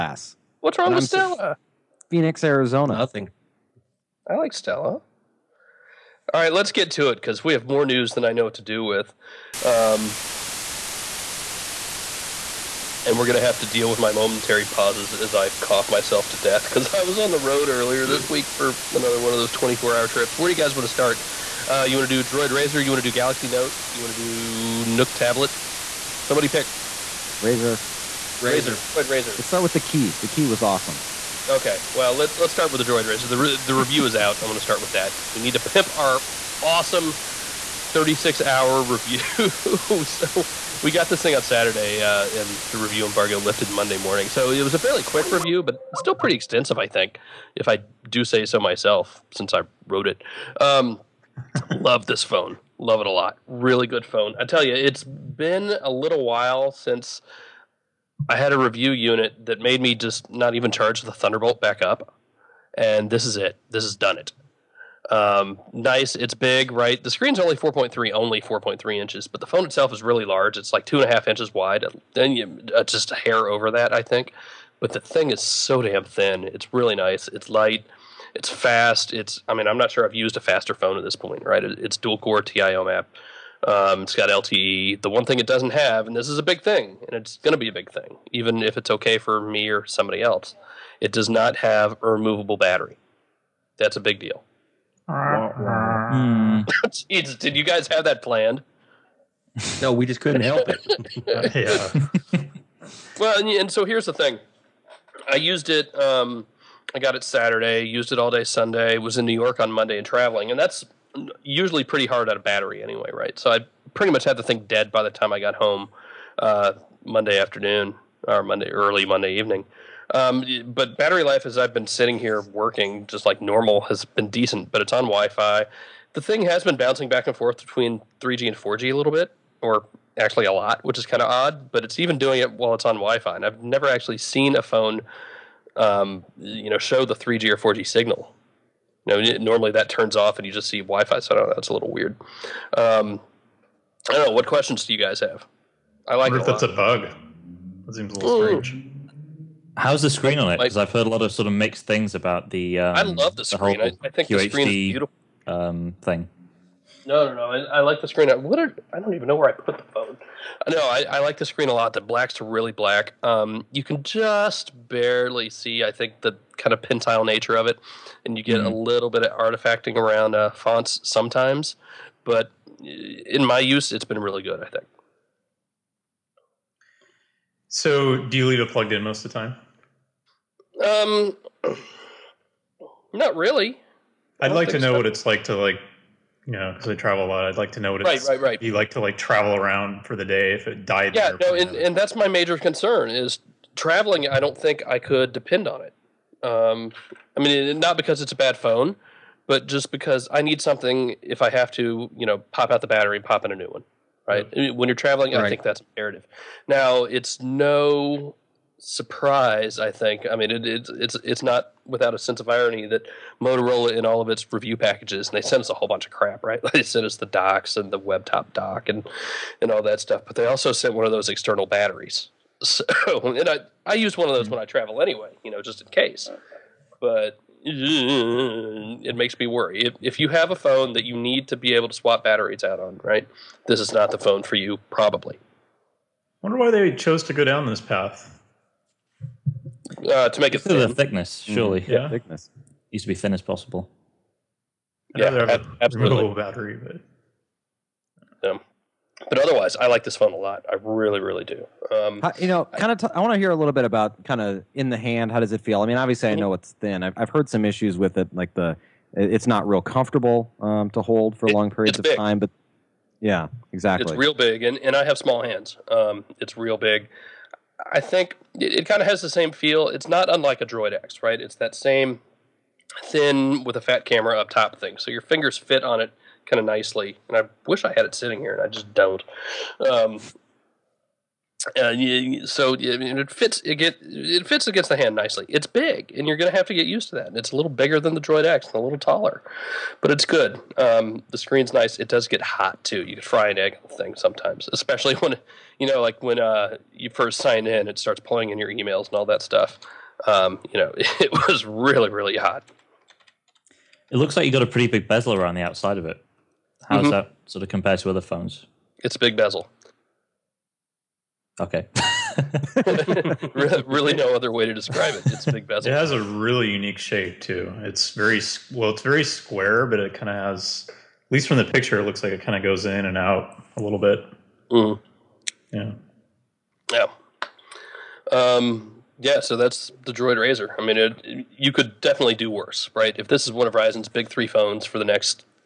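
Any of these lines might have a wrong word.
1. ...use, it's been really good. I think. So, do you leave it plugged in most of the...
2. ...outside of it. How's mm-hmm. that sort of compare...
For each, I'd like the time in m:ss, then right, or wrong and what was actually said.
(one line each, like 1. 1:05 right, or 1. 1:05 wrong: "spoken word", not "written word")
1. 2:53 right
2. 5:05 right.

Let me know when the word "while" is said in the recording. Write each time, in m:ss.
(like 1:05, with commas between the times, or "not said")
0:56, 2:12.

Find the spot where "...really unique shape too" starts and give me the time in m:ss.
5:16.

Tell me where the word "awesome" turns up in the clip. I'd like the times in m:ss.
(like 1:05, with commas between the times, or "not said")
0:30, 0:36.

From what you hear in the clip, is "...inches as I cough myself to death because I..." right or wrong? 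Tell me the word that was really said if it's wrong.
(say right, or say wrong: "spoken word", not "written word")
wrong: "pauses", not "inches".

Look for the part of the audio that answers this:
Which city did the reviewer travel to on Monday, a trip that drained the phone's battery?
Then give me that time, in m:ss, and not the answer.
1:49.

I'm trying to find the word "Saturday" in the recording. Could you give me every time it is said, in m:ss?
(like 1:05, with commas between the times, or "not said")
0:41, 1:47.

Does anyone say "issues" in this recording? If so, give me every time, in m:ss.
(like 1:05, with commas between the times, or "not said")
4:17.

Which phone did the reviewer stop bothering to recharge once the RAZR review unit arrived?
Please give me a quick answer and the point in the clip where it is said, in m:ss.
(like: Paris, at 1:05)
Thunderbolt, at 1:01.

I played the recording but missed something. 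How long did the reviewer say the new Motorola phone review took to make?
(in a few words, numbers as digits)
36 hours.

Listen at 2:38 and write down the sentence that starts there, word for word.
What are, I don't even know where I put the phone.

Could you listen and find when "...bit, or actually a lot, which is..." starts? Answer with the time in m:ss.
2:09.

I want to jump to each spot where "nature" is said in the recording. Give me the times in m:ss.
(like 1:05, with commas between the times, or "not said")
2:47.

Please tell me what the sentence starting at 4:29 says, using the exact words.
It's not unlike a Droid X, right?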